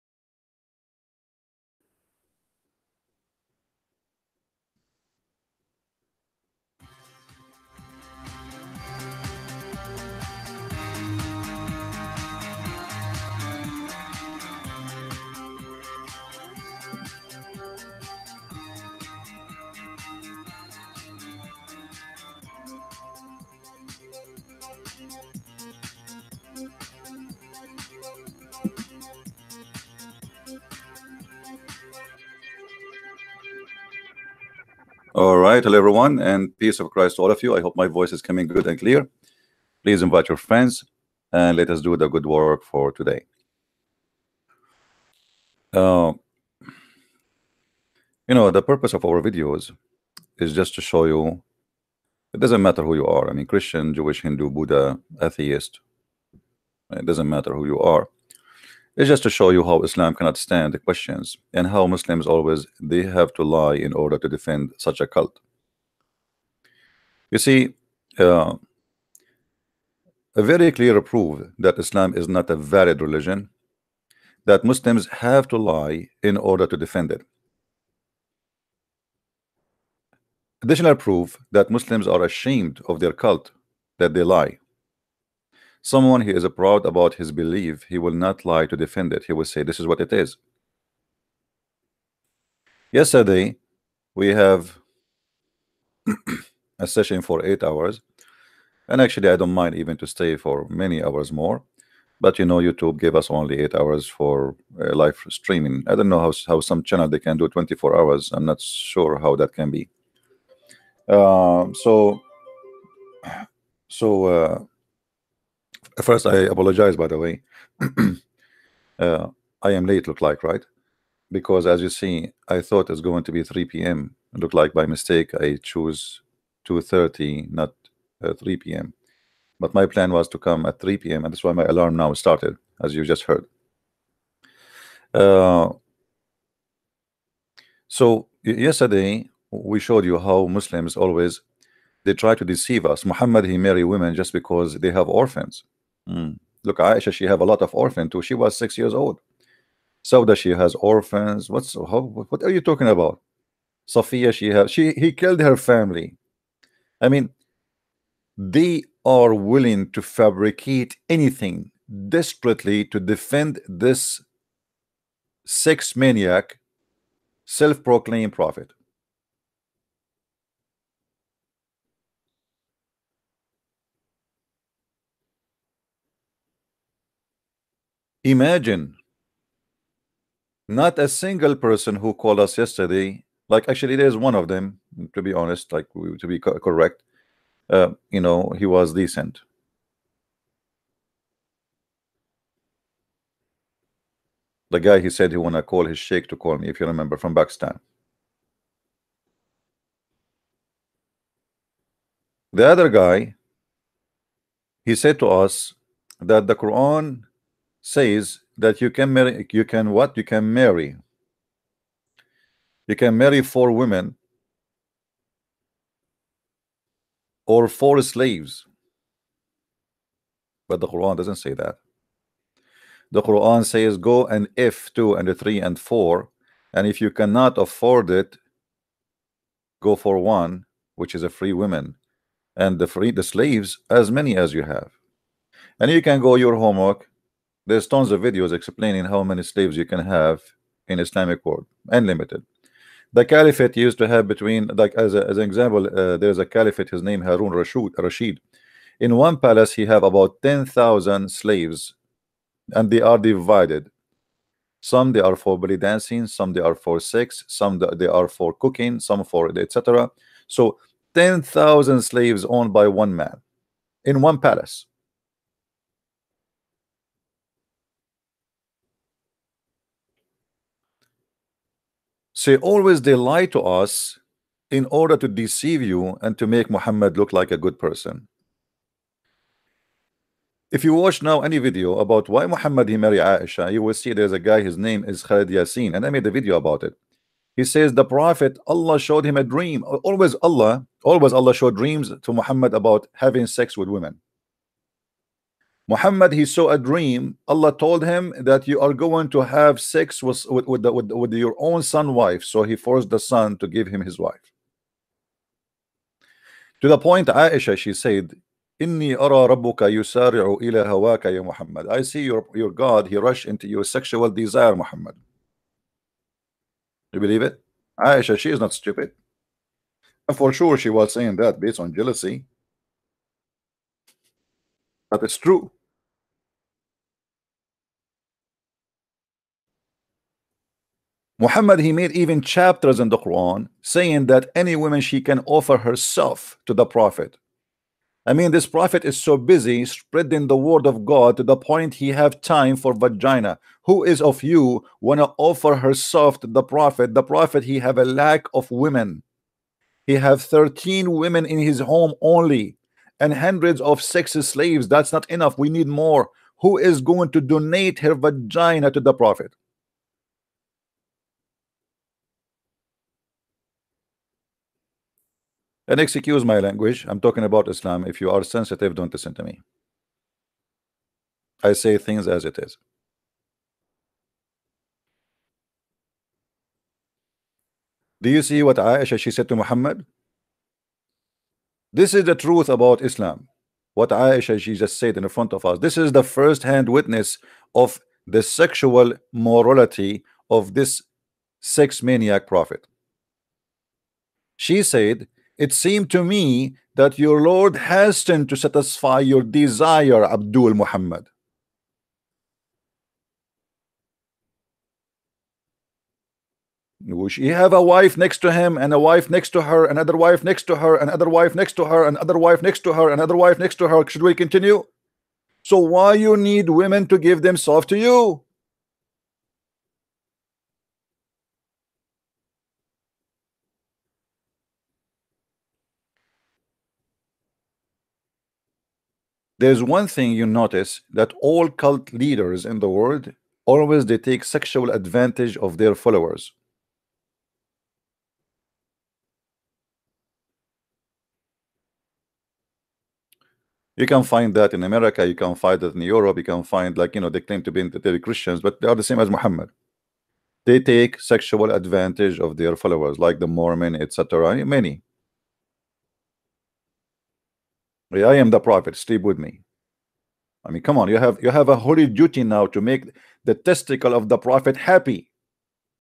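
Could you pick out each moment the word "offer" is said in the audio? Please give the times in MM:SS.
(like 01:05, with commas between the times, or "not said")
05:35, 05:45.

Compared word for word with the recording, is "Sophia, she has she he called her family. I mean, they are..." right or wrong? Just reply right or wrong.
wrong.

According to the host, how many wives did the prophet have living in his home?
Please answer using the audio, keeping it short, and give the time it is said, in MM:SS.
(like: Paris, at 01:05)
13, at 05:50.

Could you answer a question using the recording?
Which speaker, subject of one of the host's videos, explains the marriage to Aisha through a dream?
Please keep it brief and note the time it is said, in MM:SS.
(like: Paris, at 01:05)
Khalid Yasin, at 04:45.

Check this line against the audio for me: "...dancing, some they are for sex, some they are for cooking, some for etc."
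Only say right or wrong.
right.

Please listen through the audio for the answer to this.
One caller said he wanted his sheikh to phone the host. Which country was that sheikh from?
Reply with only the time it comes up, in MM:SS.
03:17.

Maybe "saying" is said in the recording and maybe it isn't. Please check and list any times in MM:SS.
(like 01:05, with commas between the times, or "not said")
05:21, 05:33.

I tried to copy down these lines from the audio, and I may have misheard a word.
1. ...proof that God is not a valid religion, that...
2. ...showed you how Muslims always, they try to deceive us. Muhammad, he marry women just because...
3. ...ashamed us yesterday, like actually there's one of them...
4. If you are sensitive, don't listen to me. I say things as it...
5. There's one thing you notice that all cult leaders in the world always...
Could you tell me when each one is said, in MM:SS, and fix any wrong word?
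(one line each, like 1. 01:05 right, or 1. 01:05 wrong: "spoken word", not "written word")
1. 01:11 wrong: "Islam", not "God"
2. 02:19 right
3. 03:02 wrong: "called", not "ashamed"
4. 06:08 right
5. 07:09 right.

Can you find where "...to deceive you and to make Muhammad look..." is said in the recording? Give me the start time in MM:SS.
04:35.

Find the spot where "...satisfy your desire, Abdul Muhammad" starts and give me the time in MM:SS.
06:38.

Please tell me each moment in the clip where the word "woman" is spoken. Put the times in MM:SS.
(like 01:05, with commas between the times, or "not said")
03:51, 05:34.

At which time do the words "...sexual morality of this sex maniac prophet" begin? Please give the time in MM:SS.
06:28.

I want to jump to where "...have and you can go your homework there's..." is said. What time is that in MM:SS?
03:54.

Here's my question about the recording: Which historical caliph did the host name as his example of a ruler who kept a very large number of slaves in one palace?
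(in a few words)
Harun Rashid.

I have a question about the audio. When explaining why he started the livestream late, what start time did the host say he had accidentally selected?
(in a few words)
2:30.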